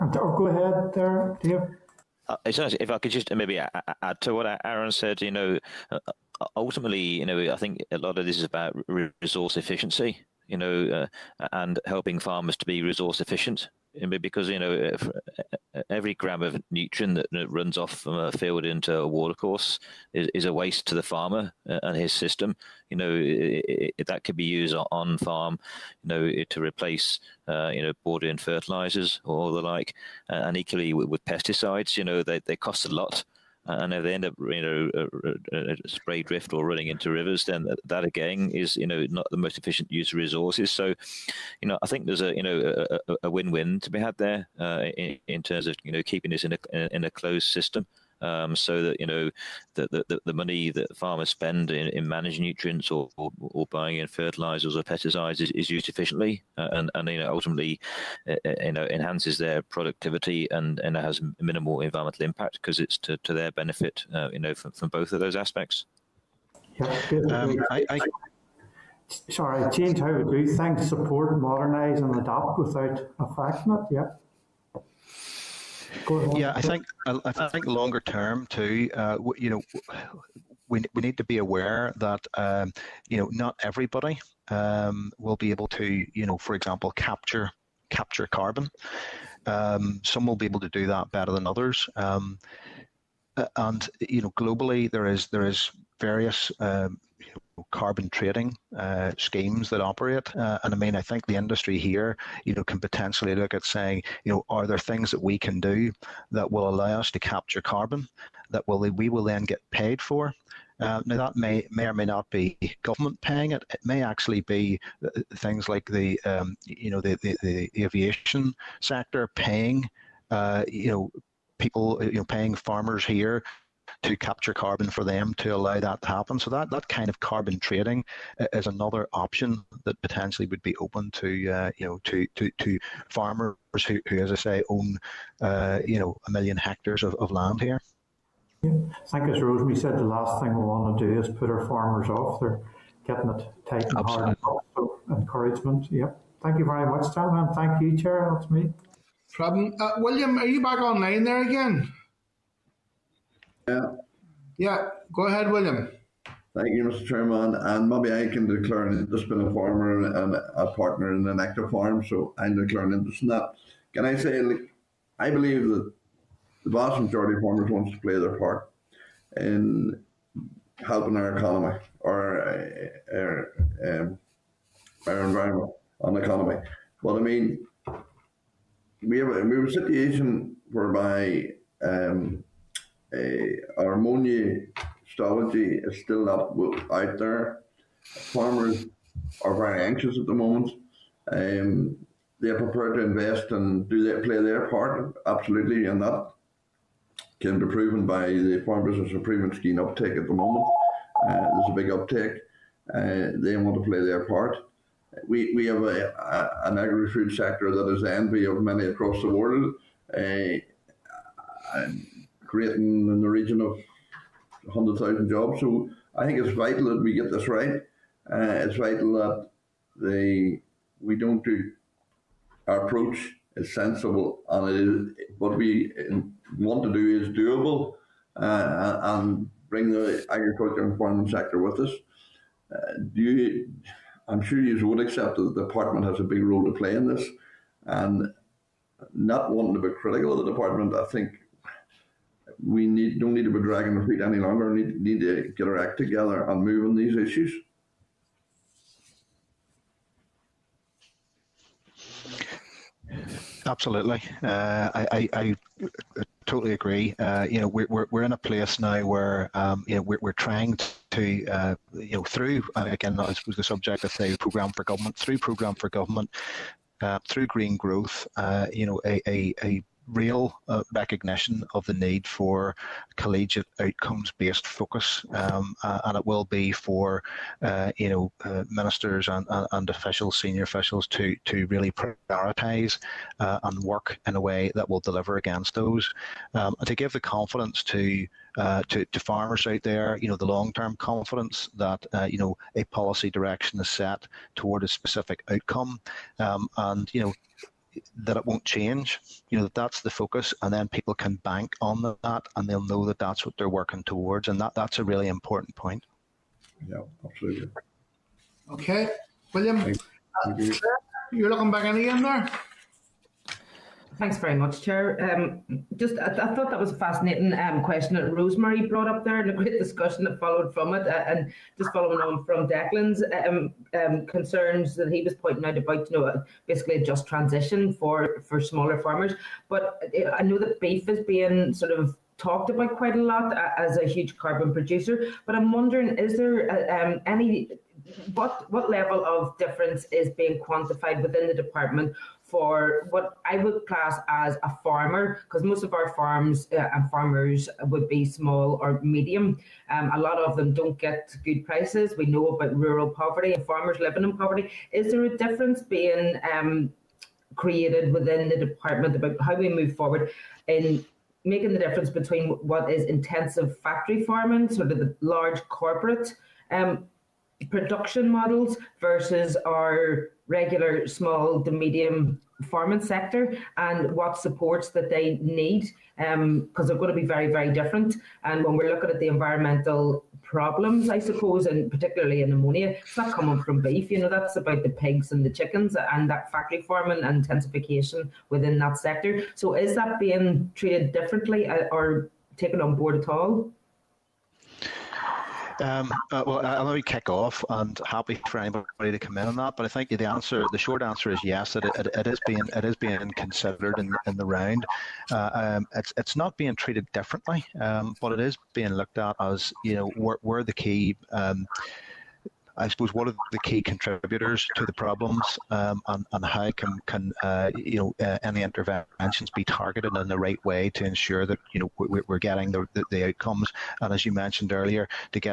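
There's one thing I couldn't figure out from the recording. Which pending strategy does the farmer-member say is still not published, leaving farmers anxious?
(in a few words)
ammonia strategy.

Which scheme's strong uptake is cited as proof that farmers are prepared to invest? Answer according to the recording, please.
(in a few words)
Farm Business Improvement Scheme.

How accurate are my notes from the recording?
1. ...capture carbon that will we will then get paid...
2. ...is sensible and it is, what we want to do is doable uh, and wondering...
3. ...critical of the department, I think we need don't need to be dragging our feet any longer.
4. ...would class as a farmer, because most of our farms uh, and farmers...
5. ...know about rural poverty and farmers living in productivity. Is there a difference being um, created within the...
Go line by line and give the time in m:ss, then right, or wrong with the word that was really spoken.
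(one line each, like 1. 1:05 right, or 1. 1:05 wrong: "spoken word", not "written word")
1. 1:47 right
2. 3:43 wrong: "bring", not "wondering"
3. 3:59 right
4. 5:43 right
5. 5:52 wrong: "poverty", not "productivity".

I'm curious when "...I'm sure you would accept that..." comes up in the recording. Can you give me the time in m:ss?
3:54.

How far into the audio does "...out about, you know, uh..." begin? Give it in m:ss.
5:25.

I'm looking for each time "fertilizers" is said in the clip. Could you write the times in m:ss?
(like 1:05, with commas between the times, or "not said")
0:28, 0:54.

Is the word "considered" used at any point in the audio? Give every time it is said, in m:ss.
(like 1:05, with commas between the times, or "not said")
6:43.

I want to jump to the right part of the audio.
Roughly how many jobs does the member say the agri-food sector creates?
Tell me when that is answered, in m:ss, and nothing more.
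3:34.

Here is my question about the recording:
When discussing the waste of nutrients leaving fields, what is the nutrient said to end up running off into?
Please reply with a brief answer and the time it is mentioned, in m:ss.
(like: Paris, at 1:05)
a watercourse, at 0:19.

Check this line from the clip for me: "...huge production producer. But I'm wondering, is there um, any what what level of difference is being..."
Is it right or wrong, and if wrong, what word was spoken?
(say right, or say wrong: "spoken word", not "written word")
wrong: "carbon", not "production".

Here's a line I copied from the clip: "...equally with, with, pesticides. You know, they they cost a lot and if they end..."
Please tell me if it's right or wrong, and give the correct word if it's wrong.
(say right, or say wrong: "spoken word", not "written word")
right.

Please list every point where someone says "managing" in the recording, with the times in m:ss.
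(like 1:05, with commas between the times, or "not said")
0:52.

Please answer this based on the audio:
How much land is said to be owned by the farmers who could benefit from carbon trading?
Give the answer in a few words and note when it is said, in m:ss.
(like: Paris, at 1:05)
a million hectares, at 2:16.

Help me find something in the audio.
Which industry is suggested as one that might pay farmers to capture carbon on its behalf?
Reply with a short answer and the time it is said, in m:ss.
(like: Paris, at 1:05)
aviation sector, at 1:57.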